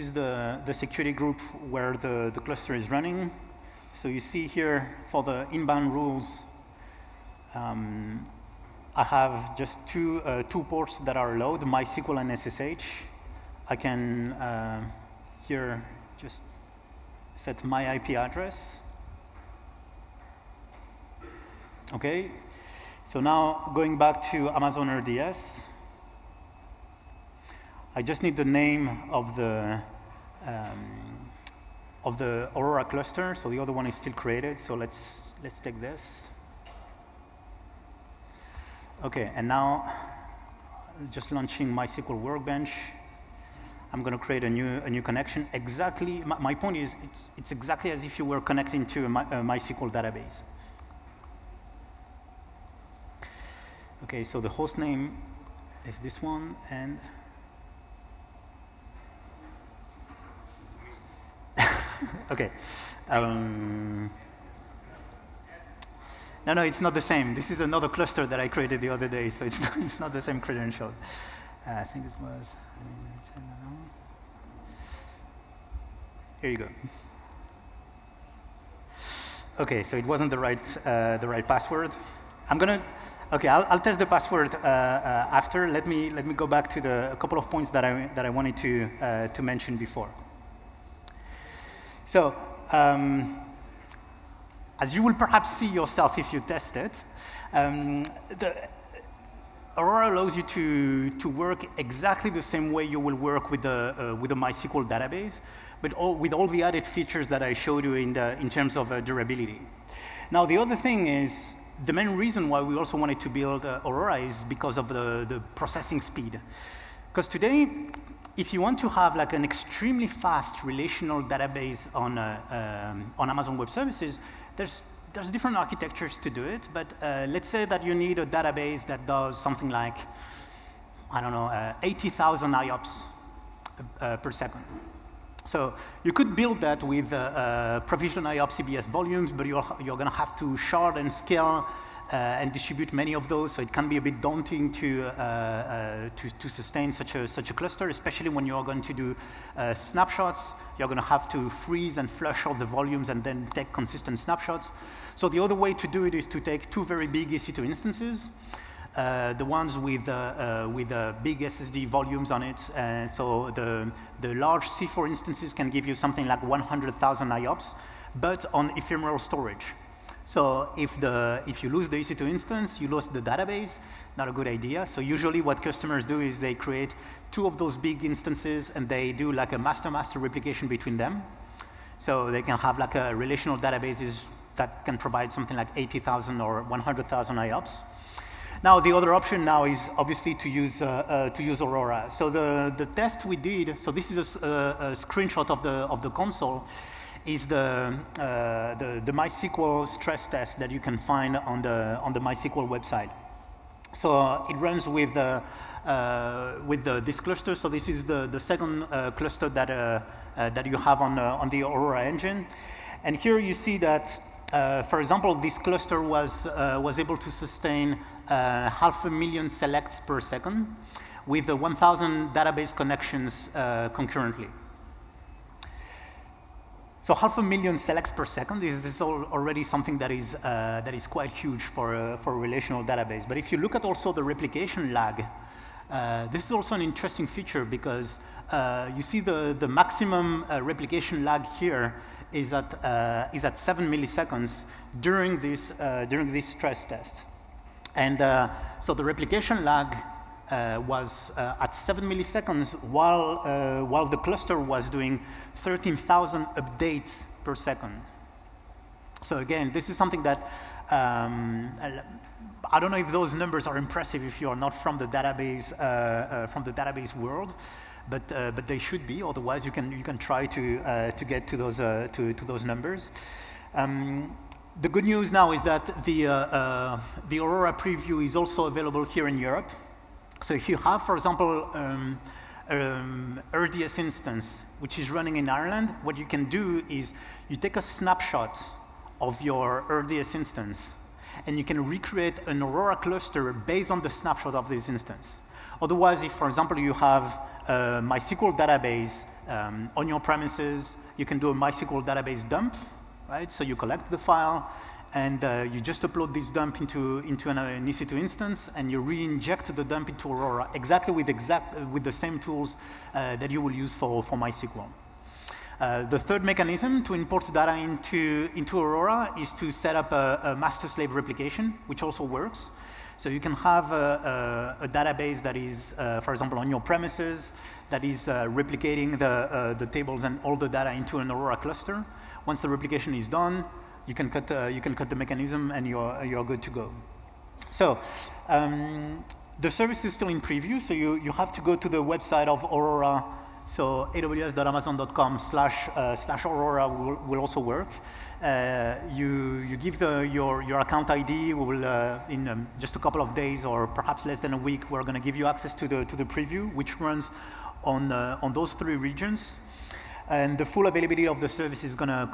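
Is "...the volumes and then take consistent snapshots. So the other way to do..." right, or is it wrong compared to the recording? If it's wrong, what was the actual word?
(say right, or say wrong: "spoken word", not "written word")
right.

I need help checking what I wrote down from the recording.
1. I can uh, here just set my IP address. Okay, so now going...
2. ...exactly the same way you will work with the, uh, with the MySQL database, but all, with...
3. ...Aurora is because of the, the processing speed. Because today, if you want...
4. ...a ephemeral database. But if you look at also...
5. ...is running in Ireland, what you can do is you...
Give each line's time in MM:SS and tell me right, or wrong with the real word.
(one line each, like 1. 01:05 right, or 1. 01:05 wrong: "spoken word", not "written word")
1. 00:13 right
2. 01:41 right
3. 01:53 right
4. 03:52 wrong: "relational", not "ephemeral"
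5. 04:44 right.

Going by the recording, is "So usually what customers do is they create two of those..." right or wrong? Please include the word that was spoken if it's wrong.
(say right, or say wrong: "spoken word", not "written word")
right.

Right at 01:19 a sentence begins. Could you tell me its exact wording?
Okay, so it wasn't the right uh, the right password.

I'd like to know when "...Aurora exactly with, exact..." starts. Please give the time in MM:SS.
05:10.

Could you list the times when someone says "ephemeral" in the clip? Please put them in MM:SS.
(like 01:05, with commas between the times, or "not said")
02:48.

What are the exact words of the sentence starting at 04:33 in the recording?
Um, the good news now is that the, the Aurora preview is also available here in Europe.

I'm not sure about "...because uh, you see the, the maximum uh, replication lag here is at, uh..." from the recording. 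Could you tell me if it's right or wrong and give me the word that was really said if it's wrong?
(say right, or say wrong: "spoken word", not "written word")
right.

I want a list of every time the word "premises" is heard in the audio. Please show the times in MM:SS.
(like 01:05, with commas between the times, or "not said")
05:00, 05:26.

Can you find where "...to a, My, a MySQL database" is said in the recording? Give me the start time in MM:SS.
00:48.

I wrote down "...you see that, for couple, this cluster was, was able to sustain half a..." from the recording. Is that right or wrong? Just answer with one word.
wrong.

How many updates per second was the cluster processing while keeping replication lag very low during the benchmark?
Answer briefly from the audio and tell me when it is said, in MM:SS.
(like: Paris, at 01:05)
13,000, at 04:15.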